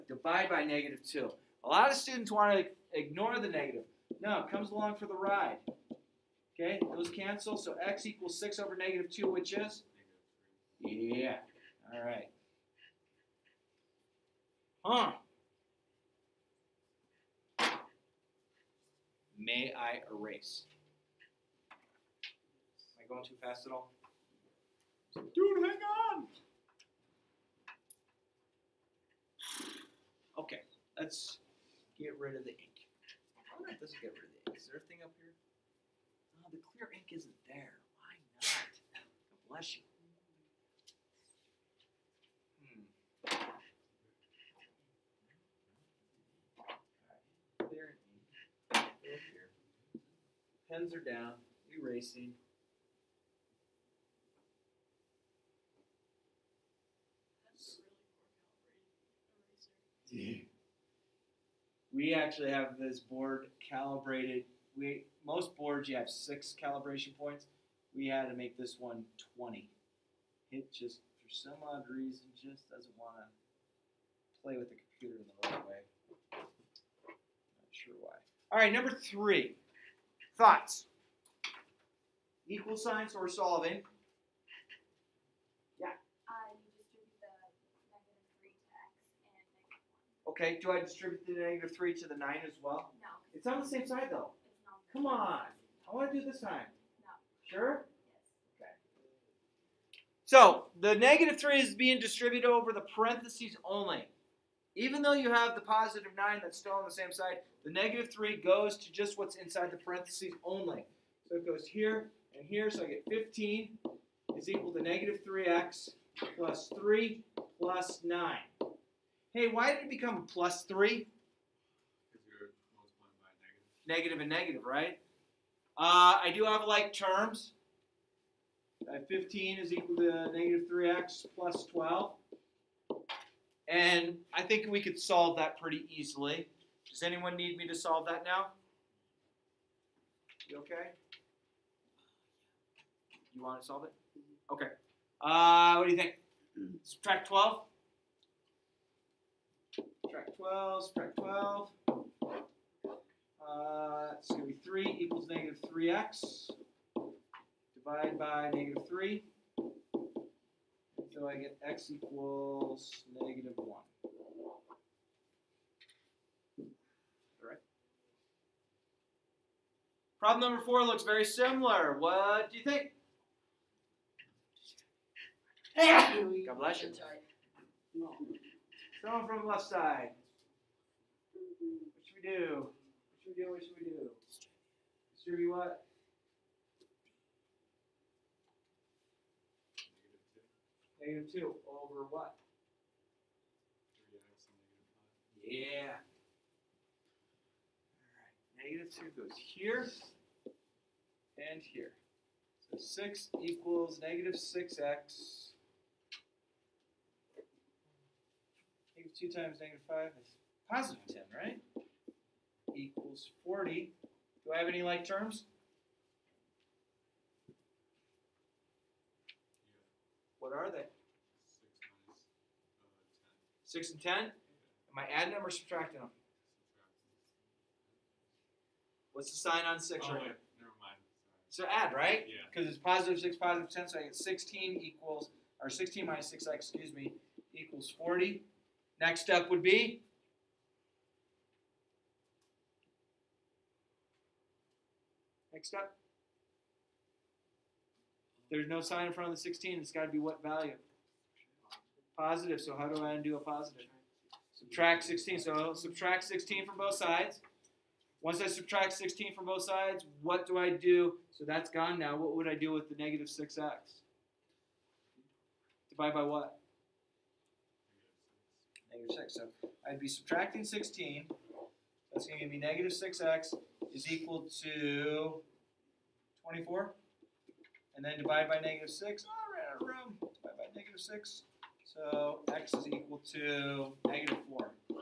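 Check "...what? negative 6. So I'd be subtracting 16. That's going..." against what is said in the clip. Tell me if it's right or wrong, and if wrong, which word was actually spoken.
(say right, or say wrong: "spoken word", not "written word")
right.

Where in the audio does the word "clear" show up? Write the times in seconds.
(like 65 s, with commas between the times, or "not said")
36 s, 47 s.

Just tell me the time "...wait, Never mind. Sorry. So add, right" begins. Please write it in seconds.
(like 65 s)
230 s.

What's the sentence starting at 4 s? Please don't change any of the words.
No, it comes along for the ride.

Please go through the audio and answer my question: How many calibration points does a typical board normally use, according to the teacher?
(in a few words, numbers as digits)
6.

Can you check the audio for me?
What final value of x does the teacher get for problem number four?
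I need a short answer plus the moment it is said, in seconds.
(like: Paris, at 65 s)
-4, at 284 s.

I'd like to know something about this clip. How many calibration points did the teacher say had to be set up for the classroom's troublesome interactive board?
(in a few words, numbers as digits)
20.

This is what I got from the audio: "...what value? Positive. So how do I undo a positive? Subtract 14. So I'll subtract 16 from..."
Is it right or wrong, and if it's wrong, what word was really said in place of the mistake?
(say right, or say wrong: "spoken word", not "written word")
wrong: "16", not "14".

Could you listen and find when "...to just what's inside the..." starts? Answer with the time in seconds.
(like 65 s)
108 s.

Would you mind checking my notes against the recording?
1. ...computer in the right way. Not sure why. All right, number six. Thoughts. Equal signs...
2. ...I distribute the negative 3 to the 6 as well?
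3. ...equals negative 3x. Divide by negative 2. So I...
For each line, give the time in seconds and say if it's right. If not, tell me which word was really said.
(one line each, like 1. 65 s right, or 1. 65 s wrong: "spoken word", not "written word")
1. 74 s wrong: "three", not "six"
2. 90 s wrong: "9", not "6"
3. 154 s wrong: "3", not "2".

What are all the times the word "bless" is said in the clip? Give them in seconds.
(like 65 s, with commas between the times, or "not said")
39 s, 176 s.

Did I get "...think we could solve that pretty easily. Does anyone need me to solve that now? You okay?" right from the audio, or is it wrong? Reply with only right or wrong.
right.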